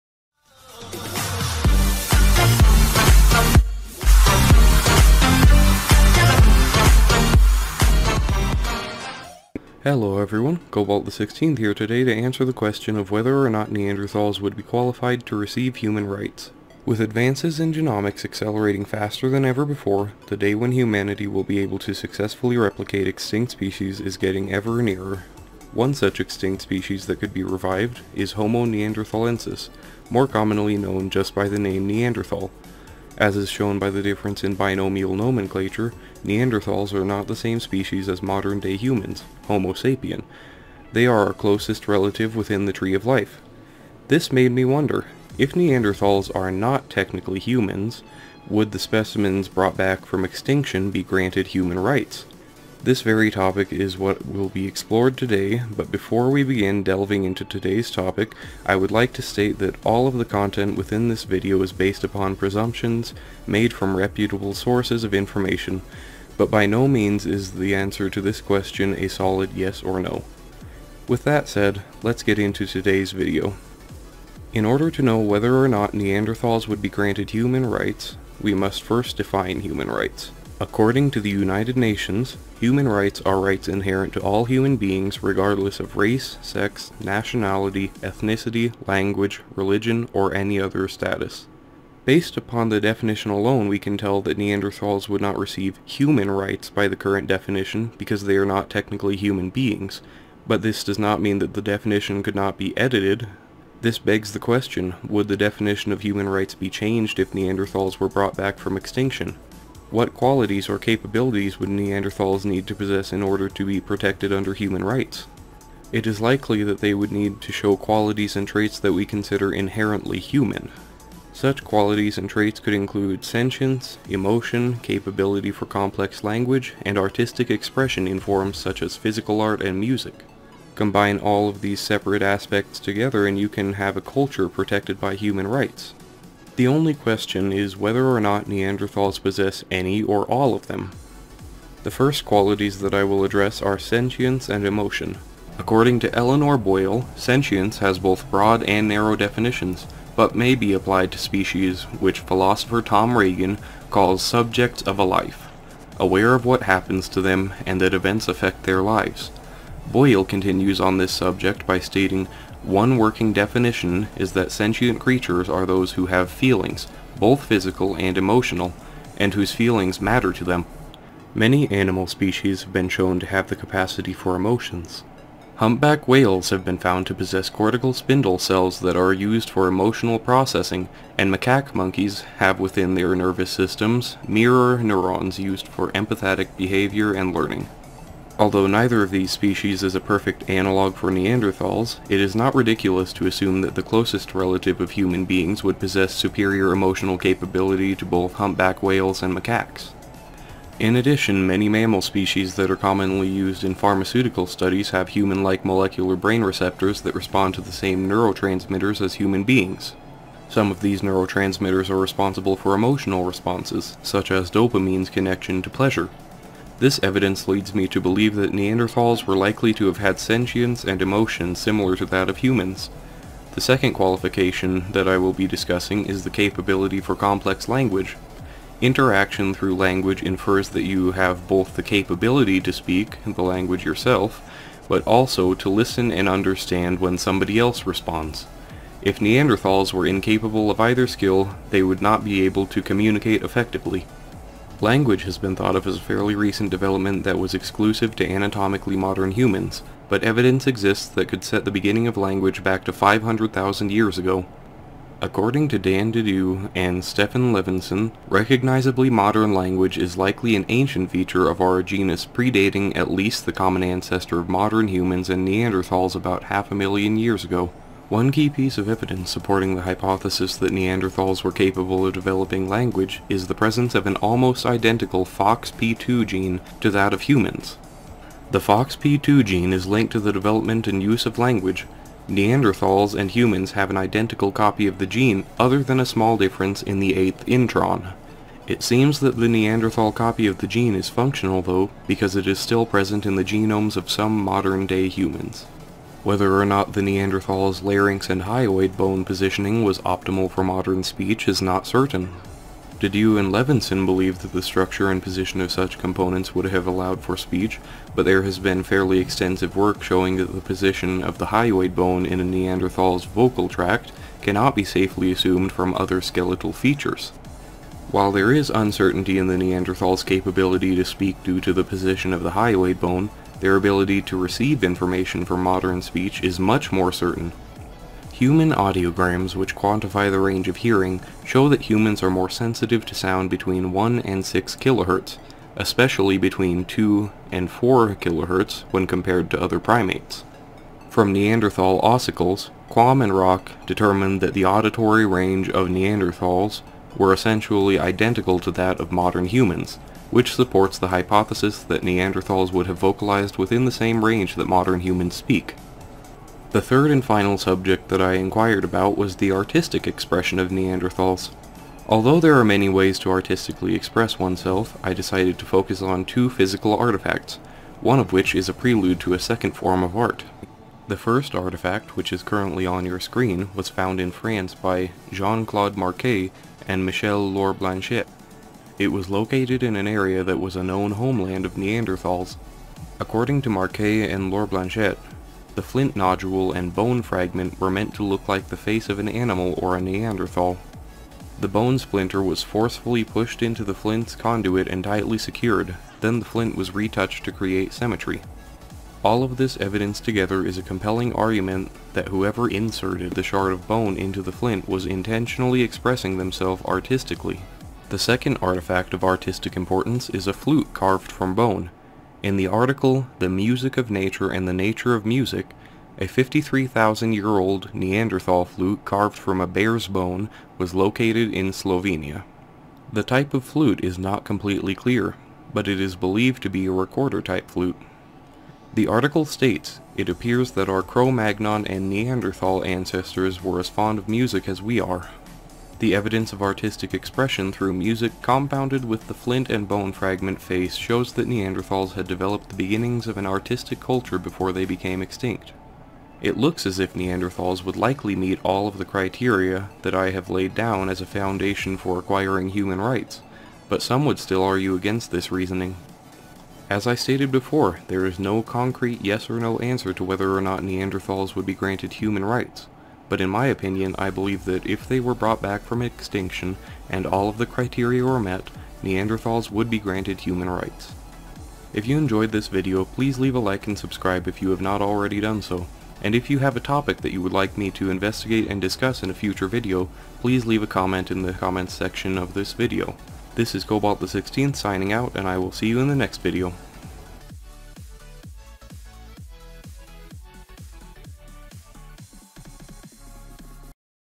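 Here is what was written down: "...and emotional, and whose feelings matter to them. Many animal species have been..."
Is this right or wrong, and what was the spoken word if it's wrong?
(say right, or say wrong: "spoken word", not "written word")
right.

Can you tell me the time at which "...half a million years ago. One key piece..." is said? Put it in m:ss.
4:26.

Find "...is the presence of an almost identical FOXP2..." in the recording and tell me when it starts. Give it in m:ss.
4:33.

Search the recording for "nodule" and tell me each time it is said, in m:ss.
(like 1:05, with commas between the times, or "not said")
6:26.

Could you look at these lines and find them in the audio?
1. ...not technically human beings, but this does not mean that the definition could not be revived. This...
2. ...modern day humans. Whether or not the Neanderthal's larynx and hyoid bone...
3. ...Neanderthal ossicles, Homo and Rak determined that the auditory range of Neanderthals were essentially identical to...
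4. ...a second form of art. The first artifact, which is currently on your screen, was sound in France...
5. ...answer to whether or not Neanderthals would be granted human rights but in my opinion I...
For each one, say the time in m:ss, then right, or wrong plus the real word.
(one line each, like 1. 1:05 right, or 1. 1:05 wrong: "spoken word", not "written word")
1. 1:38 wrong: "edited", not "revived"
2. 4:54 right
3. 5:41 wrong: "Quam", not "Homo"
4. 6:09 wrong: "found", not "sound"
5. 7:39 right.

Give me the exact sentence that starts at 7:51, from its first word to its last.
If you enjoyed this video, please leave a like and subscribe if you have not already done so.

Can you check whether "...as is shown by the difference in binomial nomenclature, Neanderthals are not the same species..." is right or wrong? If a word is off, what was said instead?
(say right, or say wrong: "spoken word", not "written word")
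right.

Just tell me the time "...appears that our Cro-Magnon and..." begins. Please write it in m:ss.
7:10.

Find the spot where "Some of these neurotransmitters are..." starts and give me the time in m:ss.
3:30.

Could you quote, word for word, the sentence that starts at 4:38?
The FOXP2 gene is linked to the development and use of language.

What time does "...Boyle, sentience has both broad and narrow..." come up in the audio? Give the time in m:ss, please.
2:26.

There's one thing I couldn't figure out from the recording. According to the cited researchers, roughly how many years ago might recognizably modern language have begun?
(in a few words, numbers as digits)
500,000 years.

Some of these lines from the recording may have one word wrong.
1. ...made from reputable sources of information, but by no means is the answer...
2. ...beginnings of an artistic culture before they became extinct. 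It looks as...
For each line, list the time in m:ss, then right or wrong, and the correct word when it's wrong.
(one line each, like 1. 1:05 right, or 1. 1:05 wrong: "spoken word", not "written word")
1. 1:03 right
2. 7:22 right.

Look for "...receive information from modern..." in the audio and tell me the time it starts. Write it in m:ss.
5:24.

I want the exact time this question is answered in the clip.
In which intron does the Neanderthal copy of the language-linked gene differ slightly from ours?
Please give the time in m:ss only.
4:47.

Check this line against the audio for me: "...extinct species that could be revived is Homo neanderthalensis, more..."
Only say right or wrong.
right.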